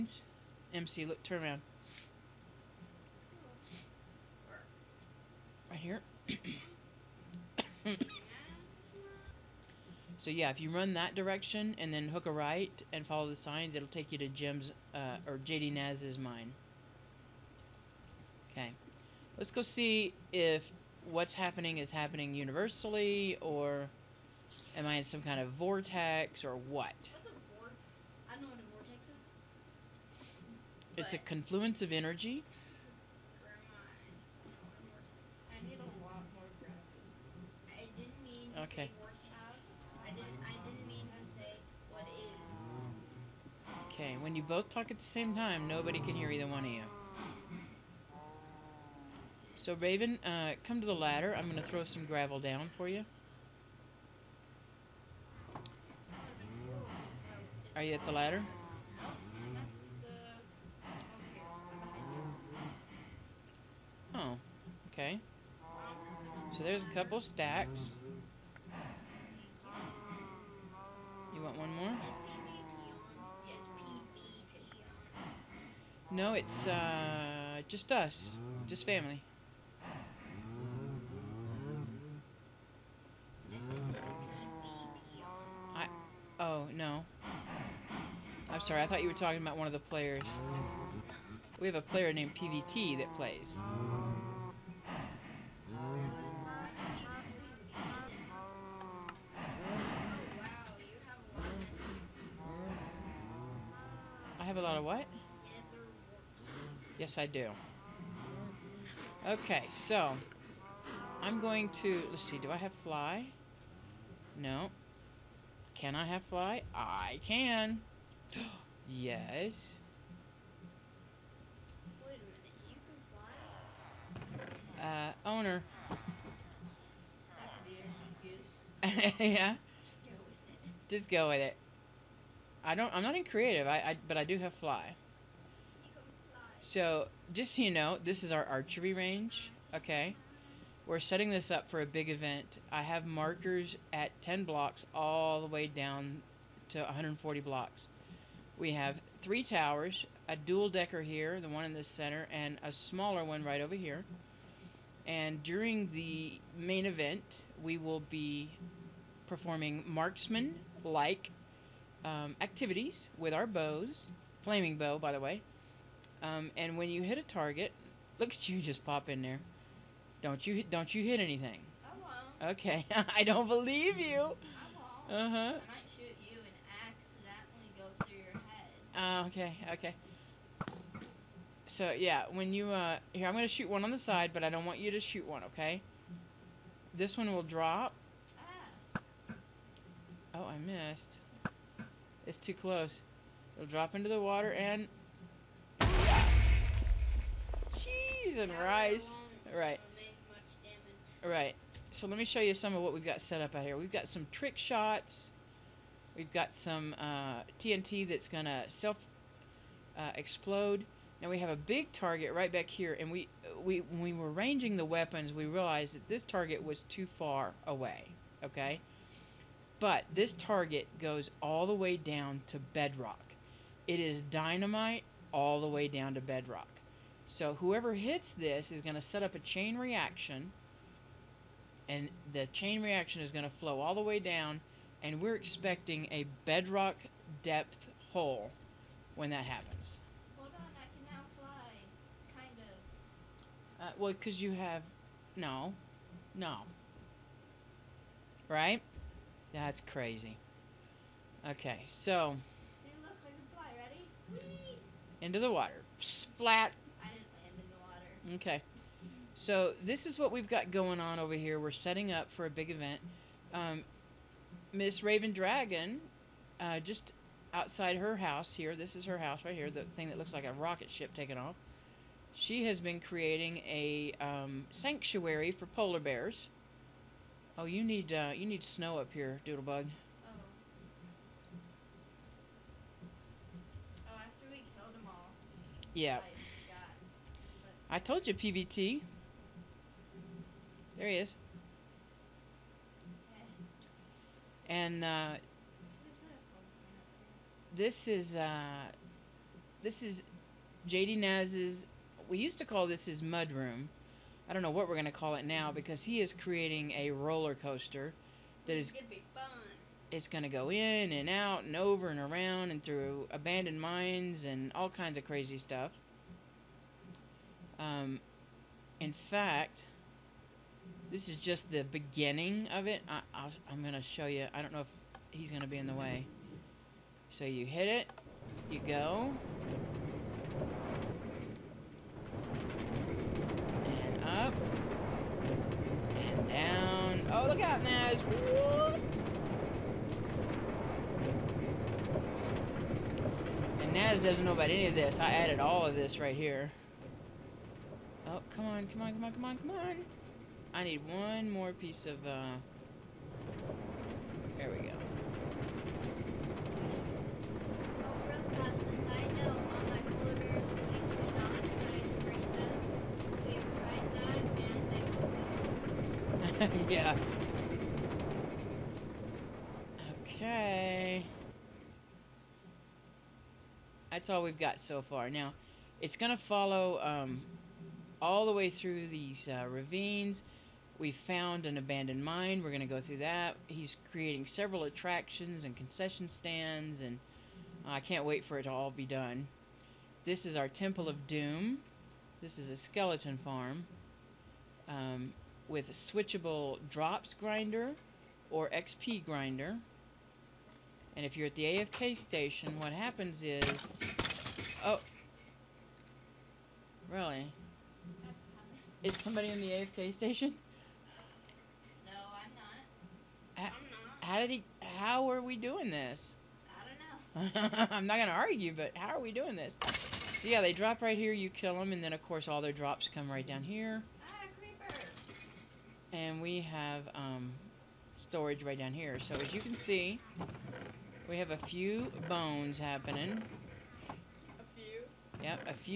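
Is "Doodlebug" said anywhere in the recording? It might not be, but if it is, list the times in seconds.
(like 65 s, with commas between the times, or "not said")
279 s.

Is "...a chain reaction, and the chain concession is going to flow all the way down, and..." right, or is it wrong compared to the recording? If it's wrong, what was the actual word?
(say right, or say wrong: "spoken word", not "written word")
wrong: "reaction", not "concession".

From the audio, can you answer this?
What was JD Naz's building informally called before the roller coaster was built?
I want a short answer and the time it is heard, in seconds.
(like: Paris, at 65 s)
Mud room, at 303 s.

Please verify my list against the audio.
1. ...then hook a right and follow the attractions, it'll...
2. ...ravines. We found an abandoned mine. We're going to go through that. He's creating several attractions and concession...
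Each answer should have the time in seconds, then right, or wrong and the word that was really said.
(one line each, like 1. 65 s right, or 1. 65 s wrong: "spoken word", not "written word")
1. 11 s wrong: "signs", not "attractions"
2. 379 s right.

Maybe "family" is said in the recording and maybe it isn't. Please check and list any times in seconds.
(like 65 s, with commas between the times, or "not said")
78 s.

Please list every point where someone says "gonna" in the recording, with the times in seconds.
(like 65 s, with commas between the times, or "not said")
183 s, 418 s.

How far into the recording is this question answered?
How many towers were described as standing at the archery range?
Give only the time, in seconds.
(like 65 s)
149 s.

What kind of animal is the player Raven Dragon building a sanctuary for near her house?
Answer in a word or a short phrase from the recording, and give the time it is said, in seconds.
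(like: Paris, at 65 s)
Polar bears, at 275 s.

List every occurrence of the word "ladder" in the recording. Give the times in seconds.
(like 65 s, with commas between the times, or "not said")
50 s, 58 s.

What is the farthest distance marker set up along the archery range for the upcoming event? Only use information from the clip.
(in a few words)
140 blocks.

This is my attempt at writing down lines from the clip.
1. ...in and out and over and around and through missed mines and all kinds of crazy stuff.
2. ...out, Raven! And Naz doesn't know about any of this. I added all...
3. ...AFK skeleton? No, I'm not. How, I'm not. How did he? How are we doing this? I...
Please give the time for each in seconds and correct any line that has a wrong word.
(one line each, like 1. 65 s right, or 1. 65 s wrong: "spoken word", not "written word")
1. 310 s wrong: "abandoned", not "missed"
2. 337 s wrong: "Naz", not "Raven"
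3. 409 s wrong: "station", not "skeleton".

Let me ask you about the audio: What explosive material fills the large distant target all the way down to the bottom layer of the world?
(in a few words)
Dynamite.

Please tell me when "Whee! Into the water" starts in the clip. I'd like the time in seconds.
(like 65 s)
254 s.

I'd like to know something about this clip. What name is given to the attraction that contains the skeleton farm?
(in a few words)
Temple of Doom.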